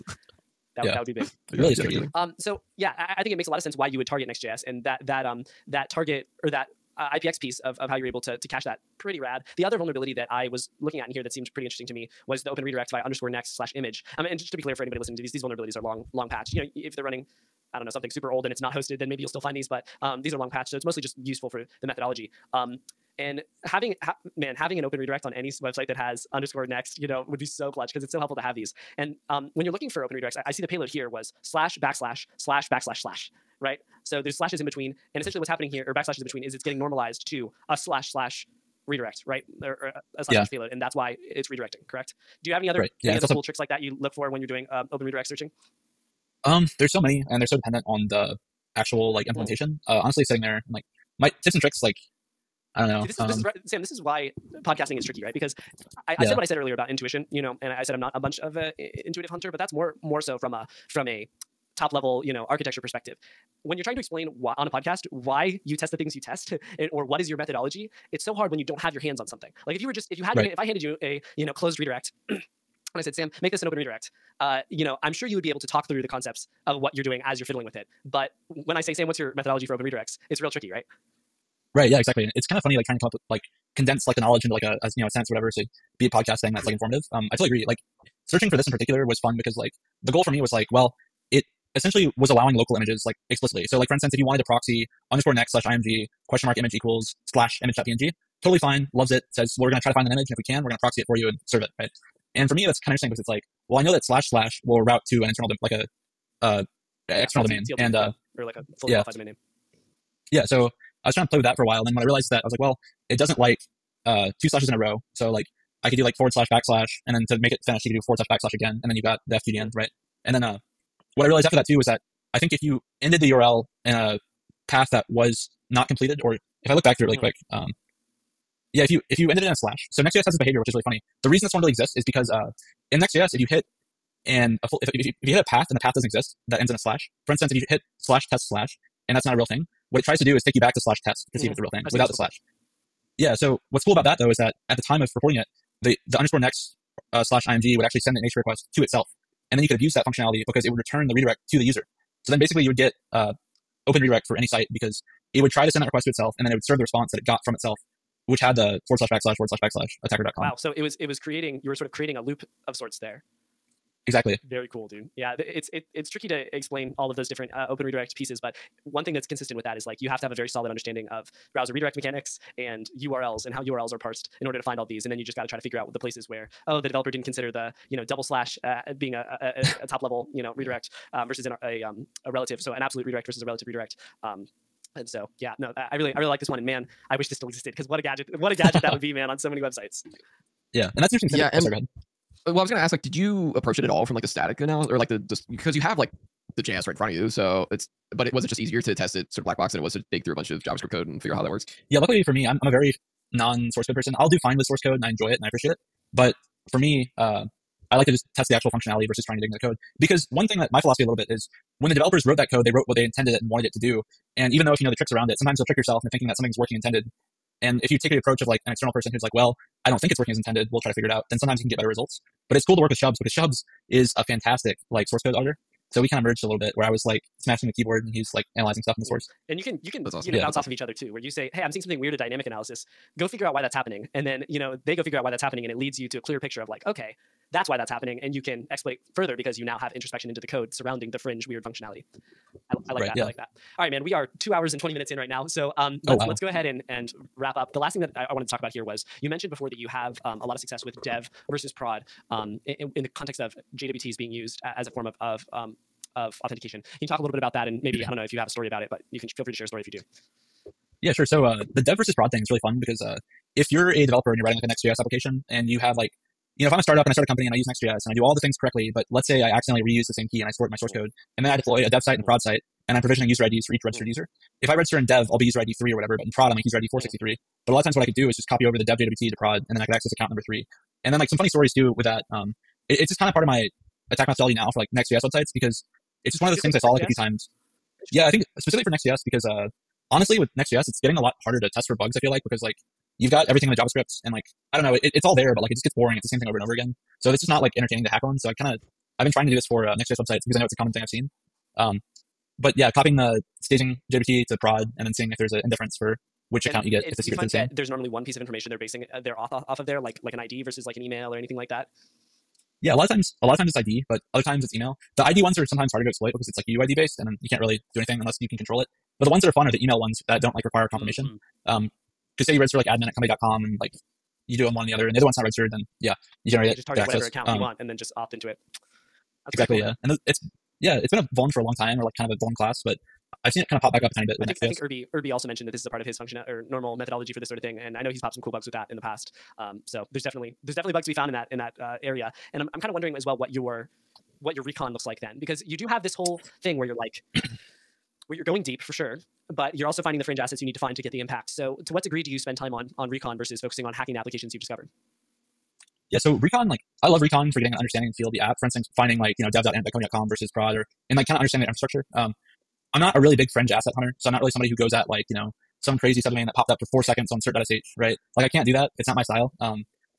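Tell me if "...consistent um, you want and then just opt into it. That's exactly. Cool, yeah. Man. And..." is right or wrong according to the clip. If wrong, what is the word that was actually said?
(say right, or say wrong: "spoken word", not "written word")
wrong: "account", not "consistent".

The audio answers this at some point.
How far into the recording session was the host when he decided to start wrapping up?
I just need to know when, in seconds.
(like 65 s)
244 s.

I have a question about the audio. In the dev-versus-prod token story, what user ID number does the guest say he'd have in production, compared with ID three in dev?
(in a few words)
463.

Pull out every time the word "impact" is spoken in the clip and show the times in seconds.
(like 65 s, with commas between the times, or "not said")
351 s.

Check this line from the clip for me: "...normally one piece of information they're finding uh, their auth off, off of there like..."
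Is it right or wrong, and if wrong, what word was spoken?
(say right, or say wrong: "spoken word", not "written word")
wrong: "basing", not "finding".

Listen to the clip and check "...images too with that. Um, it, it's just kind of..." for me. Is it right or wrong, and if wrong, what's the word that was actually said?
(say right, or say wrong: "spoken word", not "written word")
wrong: "stories", not "images".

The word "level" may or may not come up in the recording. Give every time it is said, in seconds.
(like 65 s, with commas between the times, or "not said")
61 s, 180 s.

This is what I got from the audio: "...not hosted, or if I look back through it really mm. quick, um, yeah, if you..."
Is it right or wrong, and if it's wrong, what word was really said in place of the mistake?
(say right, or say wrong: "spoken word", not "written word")
wrong: "completed", not "hosted".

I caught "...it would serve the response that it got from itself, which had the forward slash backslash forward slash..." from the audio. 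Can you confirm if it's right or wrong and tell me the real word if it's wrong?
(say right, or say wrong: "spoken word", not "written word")
right.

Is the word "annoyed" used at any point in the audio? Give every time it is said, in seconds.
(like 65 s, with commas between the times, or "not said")
not said.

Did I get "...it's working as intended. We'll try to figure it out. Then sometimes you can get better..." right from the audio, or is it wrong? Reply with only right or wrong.
right.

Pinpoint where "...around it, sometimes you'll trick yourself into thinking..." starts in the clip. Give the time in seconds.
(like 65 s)
215 s.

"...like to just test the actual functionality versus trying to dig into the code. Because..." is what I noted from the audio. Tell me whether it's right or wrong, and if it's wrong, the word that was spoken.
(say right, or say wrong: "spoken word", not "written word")
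right.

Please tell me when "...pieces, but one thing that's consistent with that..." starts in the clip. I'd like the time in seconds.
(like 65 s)
168 s.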